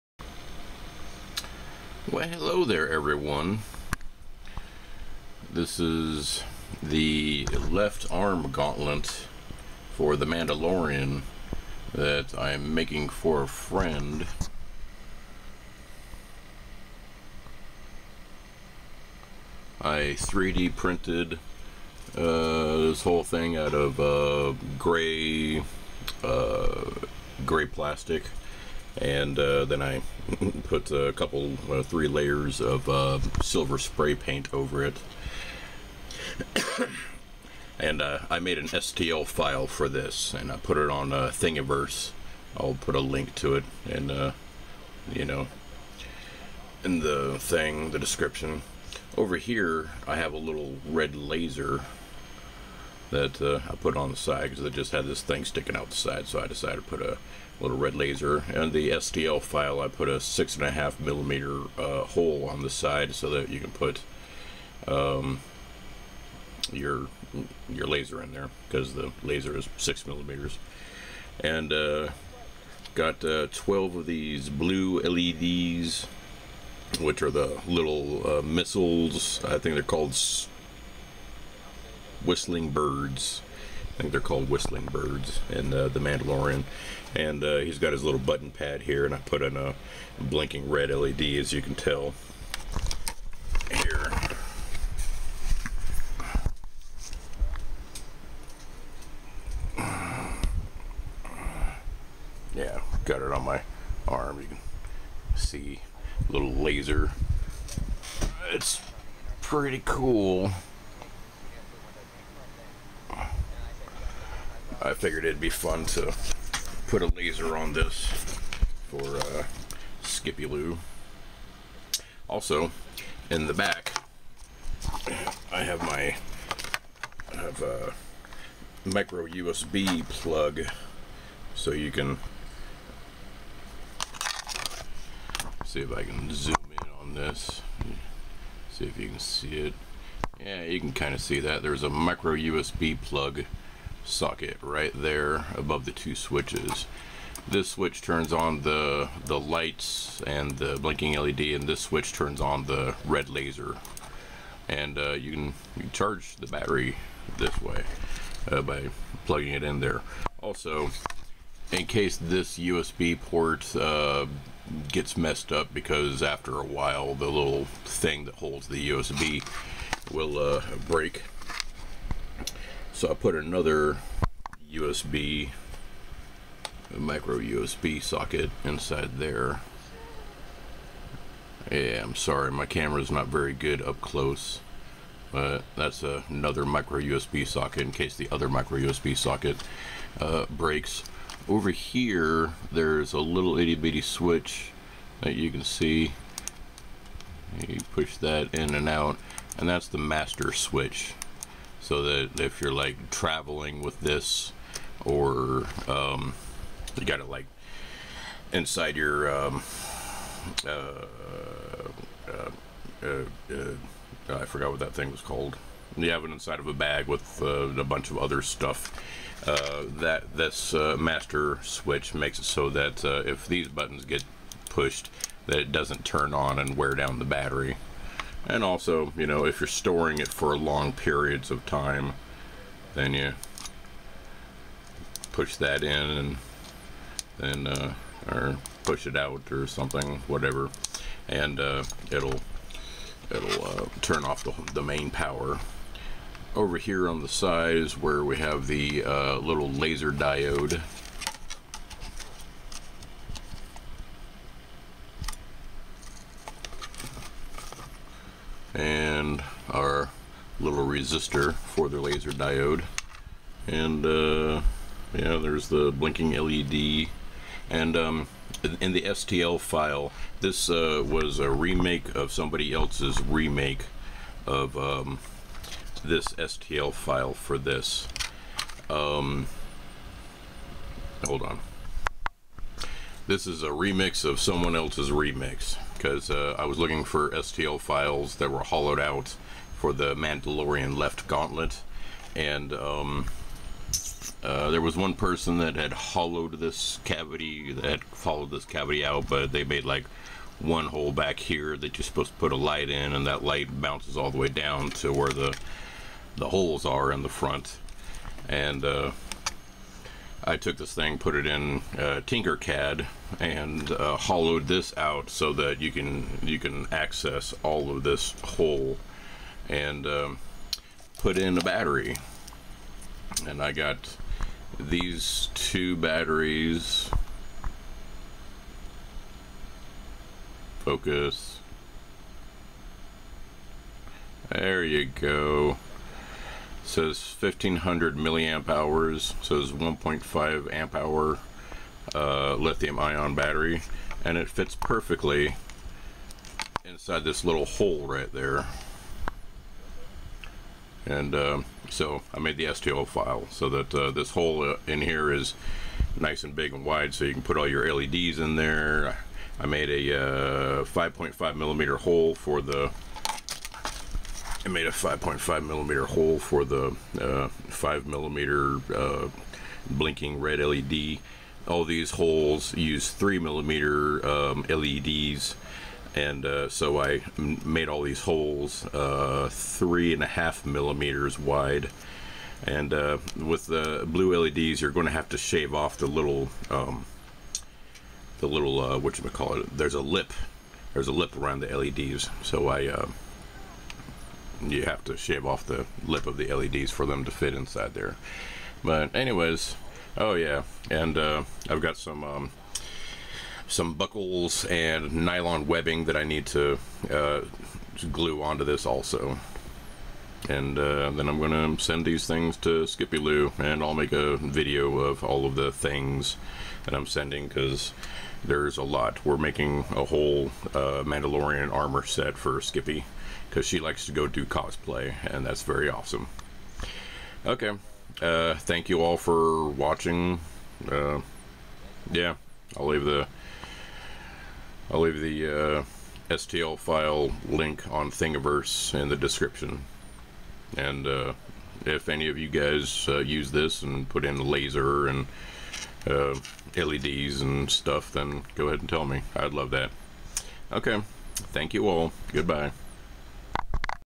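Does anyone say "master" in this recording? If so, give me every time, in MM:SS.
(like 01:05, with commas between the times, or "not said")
03:19, 03:40.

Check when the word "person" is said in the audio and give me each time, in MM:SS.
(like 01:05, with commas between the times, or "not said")
04:55.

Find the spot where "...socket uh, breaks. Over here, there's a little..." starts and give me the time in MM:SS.
03:09.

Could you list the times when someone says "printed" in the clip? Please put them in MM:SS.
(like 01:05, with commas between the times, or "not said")
00:20.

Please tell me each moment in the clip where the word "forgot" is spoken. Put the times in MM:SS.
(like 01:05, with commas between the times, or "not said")
03:34.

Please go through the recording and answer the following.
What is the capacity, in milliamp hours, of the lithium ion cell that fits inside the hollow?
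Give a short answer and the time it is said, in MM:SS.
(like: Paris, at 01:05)
1500, at 05:37.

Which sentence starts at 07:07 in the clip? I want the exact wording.
Okay, uh, thank you all for watching.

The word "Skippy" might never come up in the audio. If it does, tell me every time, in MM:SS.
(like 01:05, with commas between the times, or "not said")
02:00, 06:52, 07:02.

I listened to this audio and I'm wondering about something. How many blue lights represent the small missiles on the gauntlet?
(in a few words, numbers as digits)
12.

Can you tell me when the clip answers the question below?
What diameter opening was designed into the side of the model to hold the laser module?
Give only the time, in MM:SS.
01:00.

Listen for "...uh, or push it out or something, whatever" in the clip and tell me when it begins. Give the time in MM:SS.
03:57.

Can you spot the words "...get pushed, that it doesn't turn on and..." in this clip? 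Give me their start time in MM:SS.
03:44.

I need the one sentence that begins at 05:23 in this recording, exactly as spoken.
And I got these two batteries.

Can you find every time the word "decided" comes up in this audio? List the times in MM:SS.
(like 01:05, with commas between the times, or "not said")
00:56.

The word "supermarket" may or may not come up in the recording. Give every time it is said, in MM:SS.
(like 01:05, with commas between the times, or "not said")
not said.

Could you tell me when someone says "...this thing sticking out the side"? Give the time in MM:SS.
00:55.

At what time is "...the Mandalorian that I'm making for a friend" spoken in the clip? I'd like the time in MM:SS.
00:10.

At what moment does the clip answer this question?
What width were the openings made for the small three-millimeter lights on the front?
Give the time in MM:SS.
06:19.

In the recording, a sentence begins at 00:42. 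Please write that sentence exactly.
I'll put a link to it, and uh, you know, in the thing, the description.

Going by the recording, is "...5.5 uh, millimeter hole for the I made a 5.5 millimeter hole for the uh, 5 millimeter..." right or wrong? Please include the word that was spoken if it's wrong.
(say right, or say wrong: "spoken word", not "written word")
right.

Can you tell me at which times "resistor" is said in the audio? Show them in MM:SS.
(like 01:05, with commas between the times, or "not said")
04:20.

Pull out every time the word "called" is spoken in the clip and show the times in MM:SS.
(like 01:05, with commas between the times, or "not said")
01:19, 01:24, 03:35.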